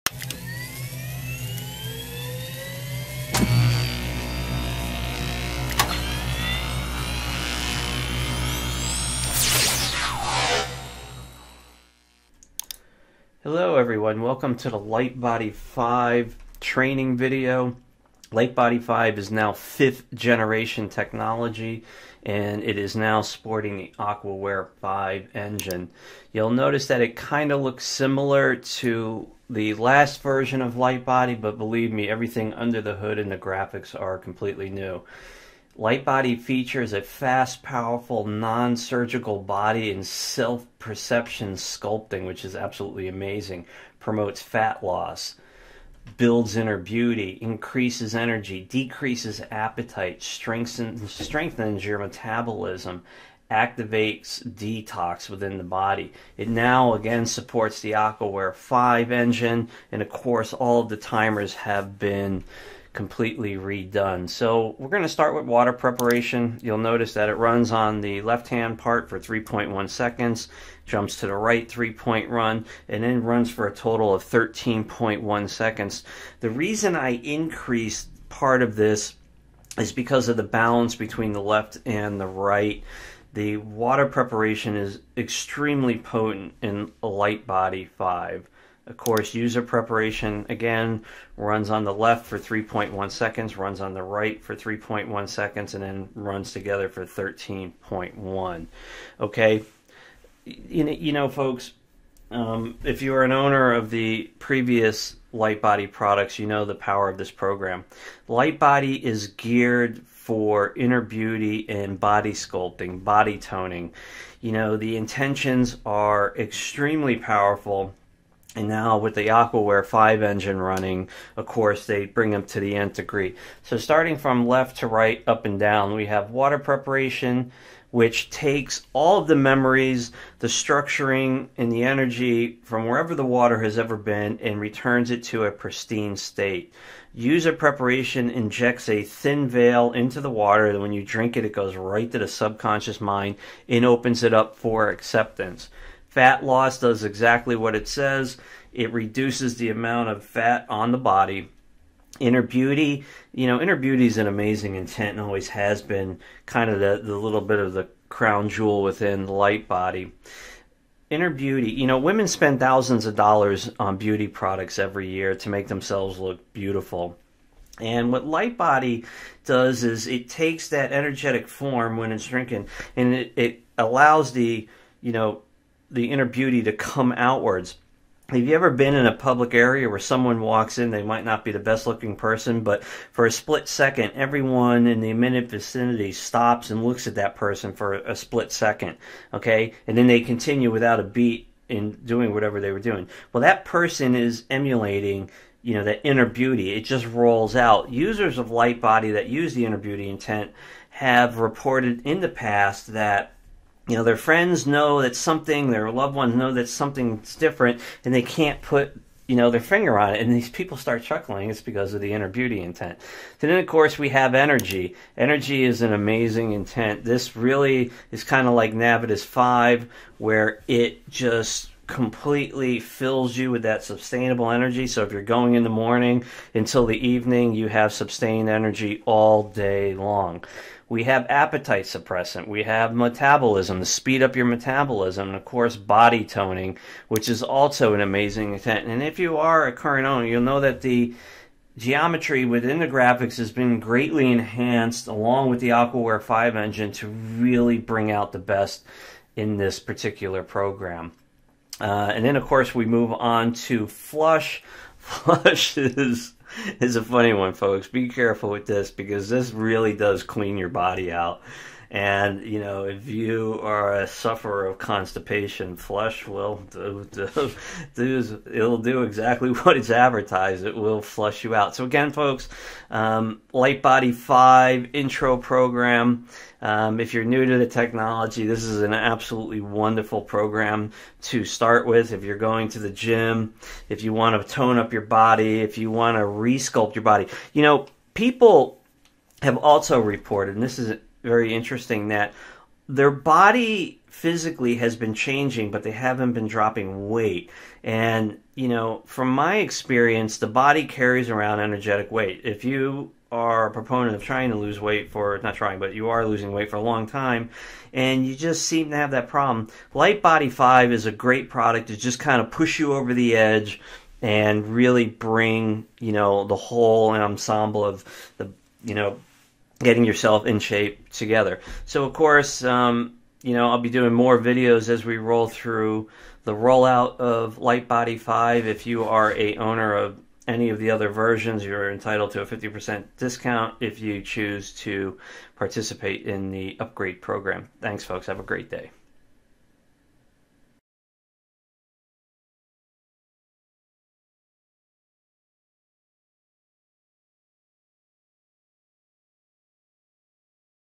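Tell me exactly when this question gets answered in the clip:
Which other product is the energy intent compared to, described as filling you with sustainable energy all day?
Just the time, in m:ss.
3:38.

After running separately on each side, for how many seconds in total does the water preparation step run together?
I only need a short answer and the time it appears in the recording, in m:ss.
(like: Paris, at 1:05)
13.1 seconds, at 1:14.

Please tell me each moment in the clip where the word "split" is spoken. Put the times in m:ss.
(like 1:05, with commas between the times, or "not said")
3:03, 3:08.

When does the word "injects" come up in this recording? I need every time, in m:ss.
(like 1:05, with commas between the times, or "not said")
2:18.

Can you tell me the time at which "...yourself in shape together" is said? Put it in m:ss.
5:20.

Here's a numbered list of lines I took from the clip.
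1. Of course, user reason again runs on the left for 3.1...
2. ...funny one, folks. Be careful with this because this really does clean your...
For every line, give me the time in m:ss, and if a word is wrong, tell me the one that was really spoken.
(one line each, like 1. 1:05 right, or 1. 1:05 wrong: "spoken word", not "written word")
1. 1:28 wrong: "preparation", not "reason"
2. 4:17 right.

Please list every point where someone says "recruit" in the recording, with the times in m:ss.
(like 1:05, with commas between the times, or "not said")
not said.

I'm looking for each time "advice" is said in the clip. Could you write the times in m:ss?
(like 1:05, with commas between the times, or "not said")
not said.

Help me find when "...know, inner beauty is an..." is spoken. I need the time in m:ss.
2:33.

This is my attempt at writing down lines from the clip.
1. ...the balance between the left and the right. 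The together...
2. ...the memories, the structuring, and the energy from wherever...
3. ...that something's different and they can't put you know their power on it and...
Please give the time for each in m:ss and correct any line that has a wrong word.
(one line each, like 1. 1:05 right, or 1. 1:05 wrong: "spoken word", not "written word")
1. 1:20 wrong: "water", not "together"
2. 2:09 right
3. 3:26 wrong: "finger", not "power".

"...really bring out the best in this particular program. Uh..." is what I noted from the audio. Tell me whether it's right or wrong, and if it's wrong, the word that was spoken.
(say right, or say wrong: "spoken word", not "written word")
right.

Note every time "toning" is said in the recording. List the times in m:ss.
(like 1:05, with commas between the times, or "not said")
1:53, 3:56.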